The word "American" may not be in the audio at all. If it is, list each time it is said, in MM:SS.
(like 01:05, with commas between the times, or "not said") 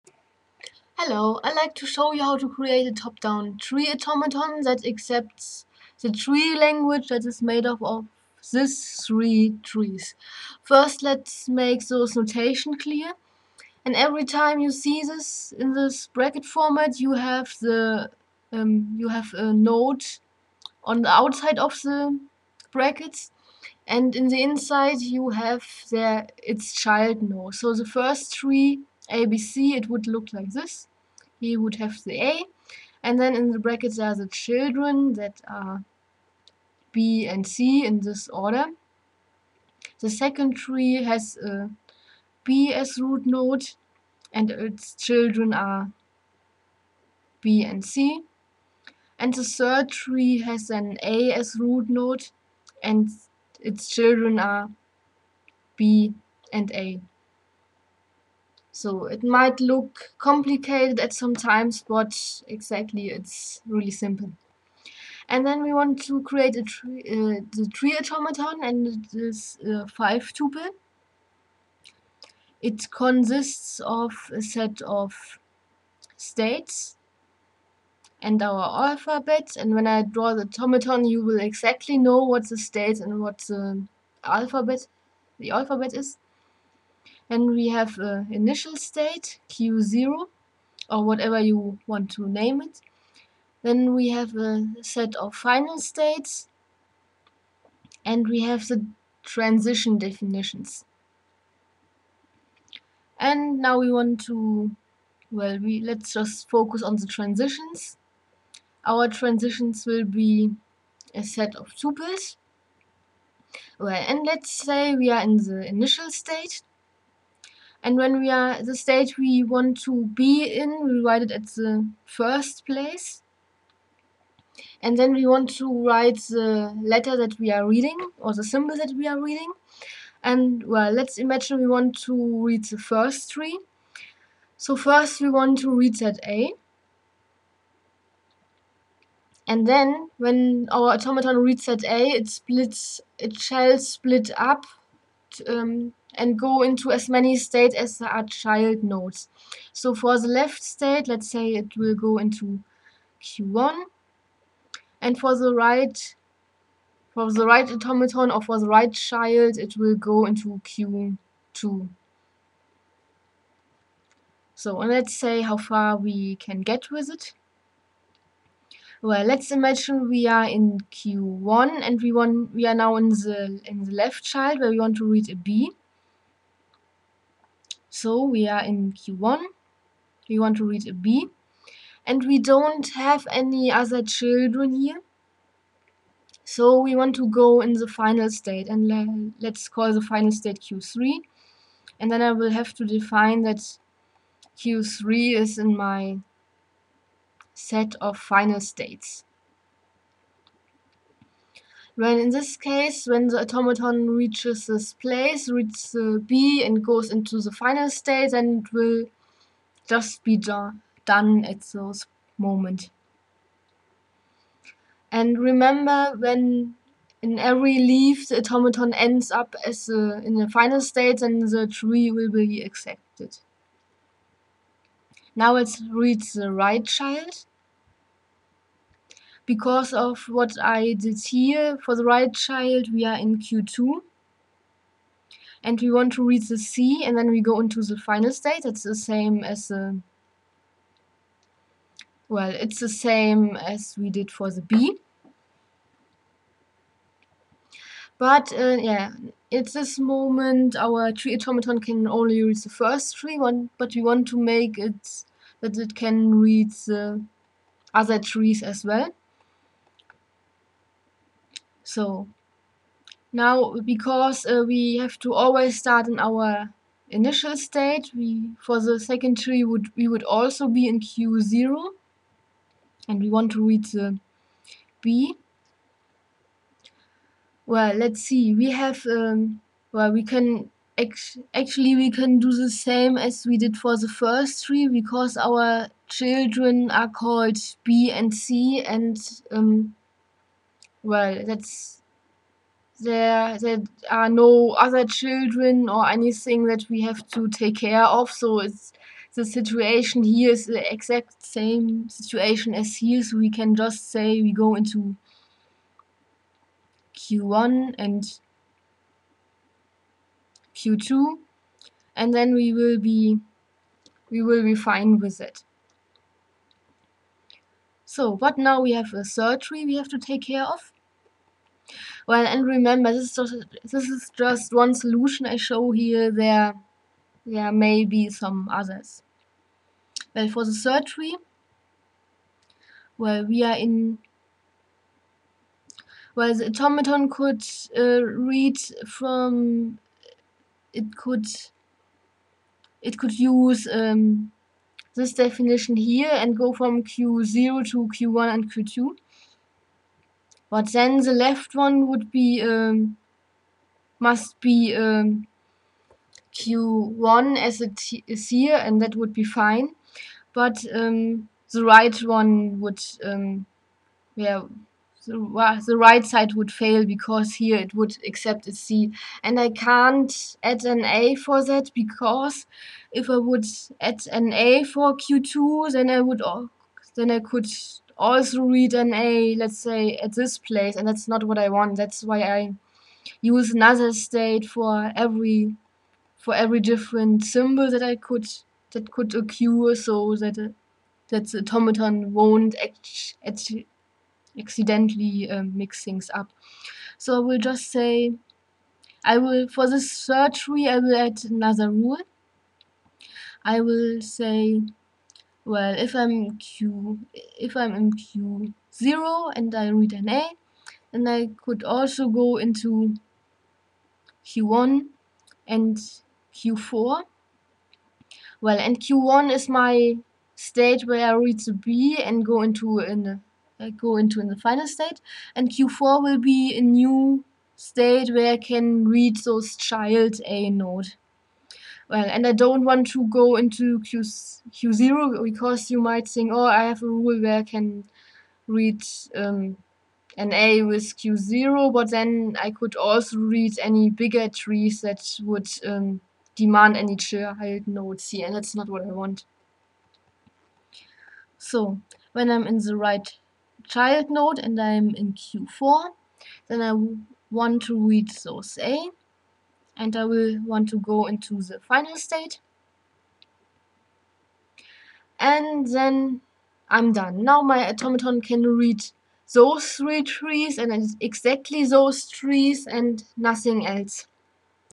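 not said.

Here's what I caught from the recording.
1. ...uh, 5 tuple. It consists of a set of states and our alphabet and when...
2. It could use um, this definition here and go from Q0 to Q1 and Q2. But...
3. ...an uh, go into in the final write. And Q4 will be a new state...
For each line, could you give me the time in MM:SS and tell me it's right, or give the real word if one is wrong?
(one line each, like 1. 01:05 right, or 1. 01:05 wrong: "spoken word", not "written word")
1. 01:09 right
2. 05:43 right
3. 07:02 wrong: "state", not "write".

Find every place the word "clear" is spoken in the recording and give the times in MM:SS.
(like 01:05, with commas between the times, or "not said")
00:12.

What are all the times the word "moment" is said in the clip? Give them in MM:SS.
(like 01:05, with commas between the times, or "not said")
03:32, 04:09.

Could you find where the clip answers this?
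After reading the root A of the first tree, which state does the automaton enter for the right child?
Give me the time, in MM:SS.
02:39.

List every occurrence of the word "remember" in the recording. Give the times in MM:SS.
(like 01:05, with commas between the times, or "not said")
03:35, 05:22.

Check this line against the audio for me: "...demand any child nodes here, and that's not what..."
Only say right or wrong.
right.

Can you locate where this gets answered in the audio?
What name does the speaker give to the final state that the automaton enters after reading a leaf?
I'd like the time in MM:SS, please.
03:09.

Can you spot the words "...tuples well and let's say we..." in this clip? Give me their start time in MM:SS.
01:51.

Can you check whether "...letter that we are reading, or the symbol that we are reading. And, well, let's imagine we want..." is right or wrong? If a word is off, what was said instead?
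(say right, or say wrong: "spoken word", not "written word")
right.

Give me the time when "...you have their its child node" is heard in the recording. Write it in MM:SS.
00:25.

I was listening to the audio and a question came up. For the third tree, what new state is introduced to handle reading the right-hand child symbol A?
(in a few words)
Q4.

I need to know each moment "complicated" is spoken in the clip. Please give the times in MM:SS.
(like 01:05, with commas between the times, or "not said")
01:00.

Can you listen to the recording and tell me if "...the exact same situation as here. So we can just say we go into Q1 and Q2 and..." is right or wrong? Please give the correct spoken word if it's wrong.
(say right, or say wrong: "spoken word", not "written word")
right.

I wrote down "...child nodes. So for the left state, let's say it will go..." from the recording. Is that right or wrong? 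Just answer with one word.
right.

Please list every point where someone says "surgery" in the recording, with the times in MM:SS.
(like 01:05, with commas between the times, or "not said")
05:19, 05:30.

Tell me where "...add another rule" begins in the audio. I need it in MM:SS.
06:41.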